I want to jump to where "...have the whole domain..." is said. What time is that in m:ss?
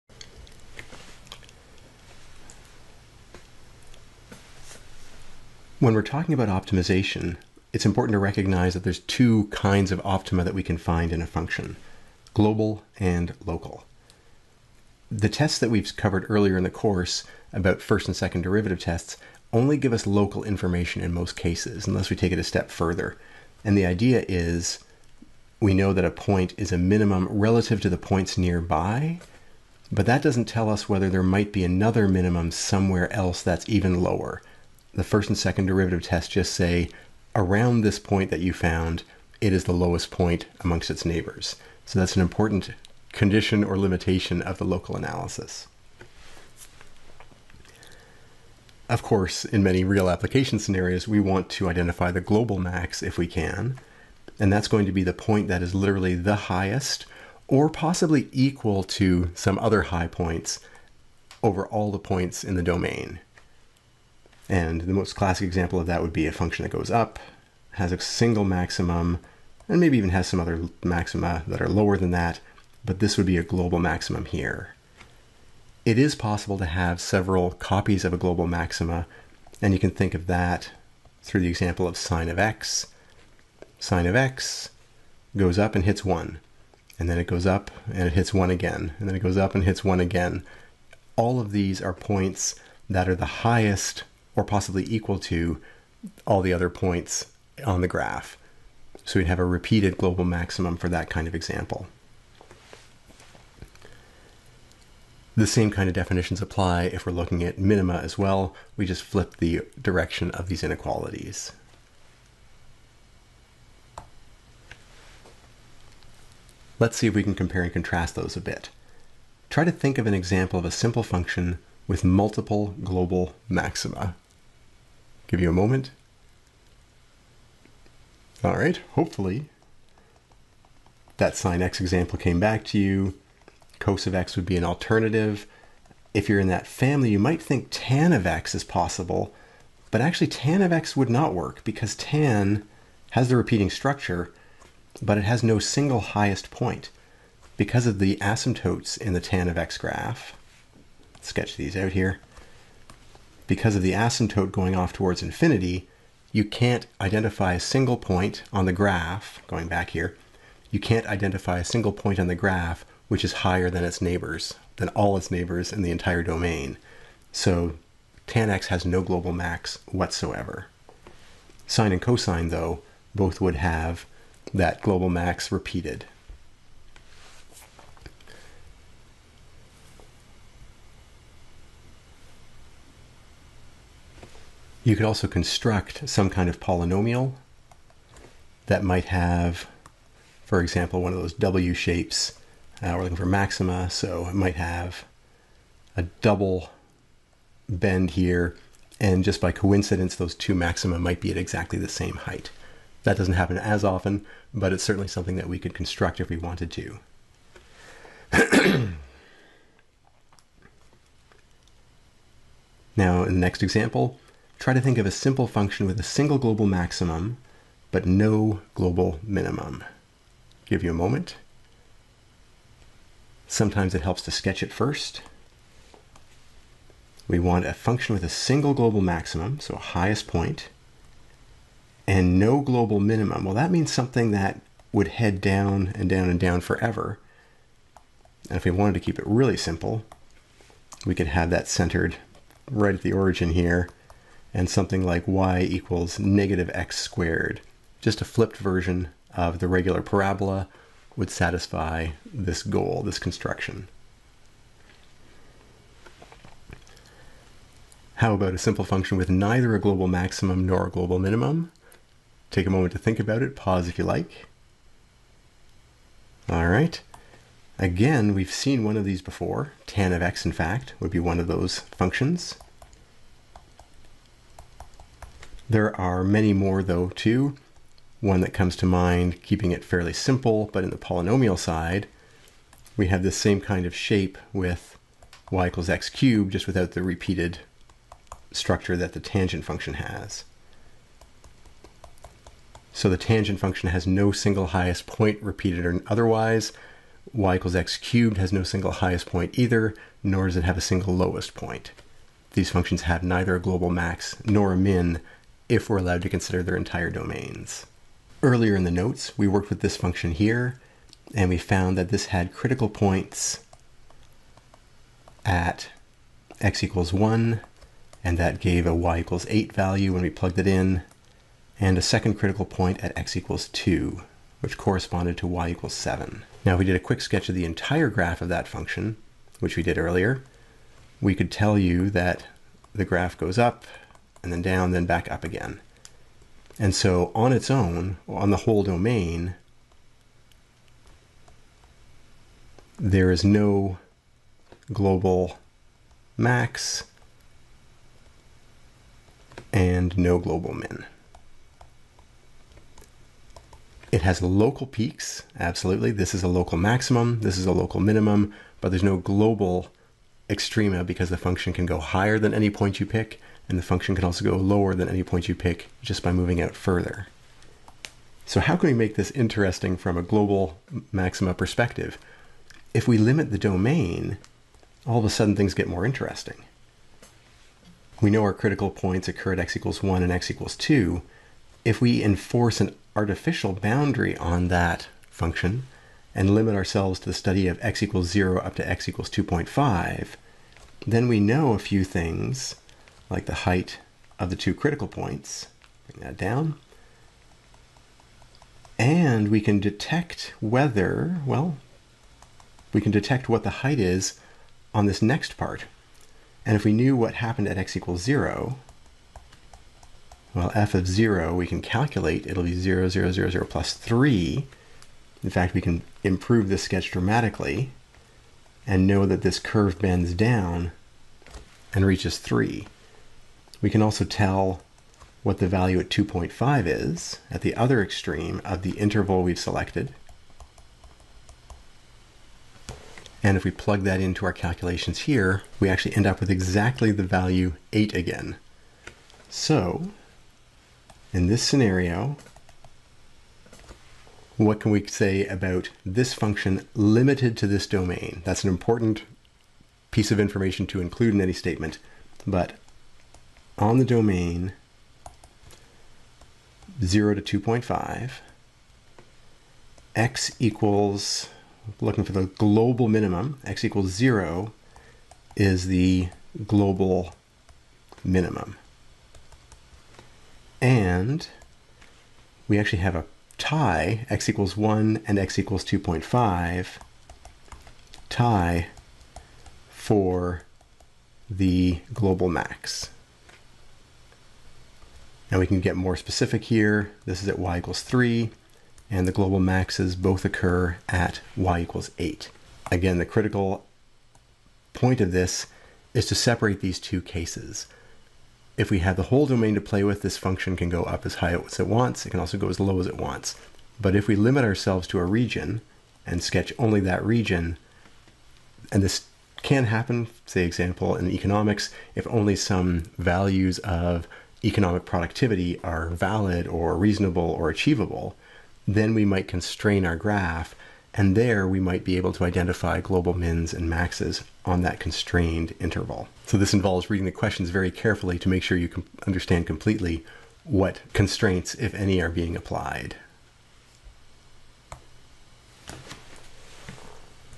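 8:18.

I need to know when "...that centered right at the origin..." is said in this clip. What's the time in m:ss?
4:01.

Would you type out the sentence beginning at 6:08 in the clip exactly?
So how can we make this interesting from a global maxima perspective?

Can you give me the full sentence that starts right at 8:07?
This is at y equals 3, and the global maxes both occur at y equals 8.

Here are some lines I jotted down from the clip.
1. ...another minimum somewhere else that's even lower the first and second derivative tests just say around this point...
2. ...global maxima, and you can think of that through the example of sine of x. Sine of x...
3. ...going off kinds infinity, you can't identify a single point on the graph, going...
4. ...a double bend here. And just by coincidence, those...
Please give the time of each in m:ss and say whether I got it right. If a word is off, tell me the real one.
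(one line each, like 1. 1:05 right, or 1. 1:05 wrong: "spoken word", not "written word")
1. 0:31 right
2. 1:18 right
3. 2:34 wrong: "towards", not "kinds"
4. 3:15 right.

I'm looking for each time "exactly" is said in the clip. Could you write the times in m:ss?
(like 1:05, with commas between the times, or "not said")
3:21, 7:16.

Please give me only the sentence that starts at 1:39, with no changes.
So we'd have a repeated global maximum for that kind of example.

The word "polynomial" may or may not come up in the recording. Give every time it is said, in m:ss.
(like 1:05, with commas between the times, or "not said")
3:06, 4:40.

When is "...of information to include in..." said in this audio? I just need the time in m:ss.
7:30.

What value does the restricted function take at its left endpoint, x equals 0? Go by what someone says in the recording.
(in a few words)
3.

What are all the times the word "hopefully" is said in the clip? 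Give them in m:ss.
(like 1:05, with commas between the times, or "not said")
2:08.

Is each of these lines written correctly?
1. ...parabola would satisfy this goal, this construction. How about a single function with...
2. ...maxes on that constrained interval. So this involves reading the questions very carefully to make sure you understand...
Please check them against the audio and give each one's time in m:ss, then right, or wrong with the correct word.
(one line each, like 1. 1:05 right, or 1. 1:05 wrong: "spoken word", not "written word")
1. 4:10 wrong: "simple", not "single"
2. 8:43 right.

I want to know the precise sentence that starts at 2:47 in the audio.
So tan x has no global max whatsoever.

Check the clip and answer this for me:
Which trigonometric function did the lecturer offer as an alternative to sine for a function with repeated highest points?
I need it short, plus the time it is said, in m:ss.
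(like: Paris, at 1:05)
cos of x, at 2:13.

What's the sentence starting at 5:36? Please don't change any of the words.
And so on its own, on the whole domain, there is no global max and no global min.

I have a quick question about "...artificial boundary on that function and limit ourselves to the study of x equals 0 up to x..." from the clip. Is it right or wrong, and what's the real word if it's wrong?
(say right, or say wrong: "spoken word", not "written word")
right.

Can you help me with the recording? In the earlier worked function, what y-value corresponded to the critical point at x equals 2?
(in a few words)
7.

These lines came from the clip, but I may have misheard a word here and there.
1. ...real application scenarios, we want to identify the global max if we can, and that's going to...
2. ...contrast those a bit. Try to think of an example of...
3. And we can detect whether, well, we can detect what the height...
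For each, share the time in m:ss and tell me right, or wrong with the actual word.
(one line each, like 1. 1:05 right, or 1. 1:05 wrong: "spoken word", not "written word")
1. 0:49 right
2. 1:57 right
3. 6:38 right.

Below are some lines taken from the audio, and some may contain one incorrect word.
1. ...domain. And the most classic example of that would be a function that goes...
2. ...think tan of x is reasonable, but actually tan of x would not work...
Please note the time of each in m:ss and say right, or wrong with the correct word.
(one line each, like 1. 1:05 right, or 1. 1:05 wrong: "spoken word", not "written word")
1. 1:02 right
2. 2:17 wrong: "possible", not "reasonable".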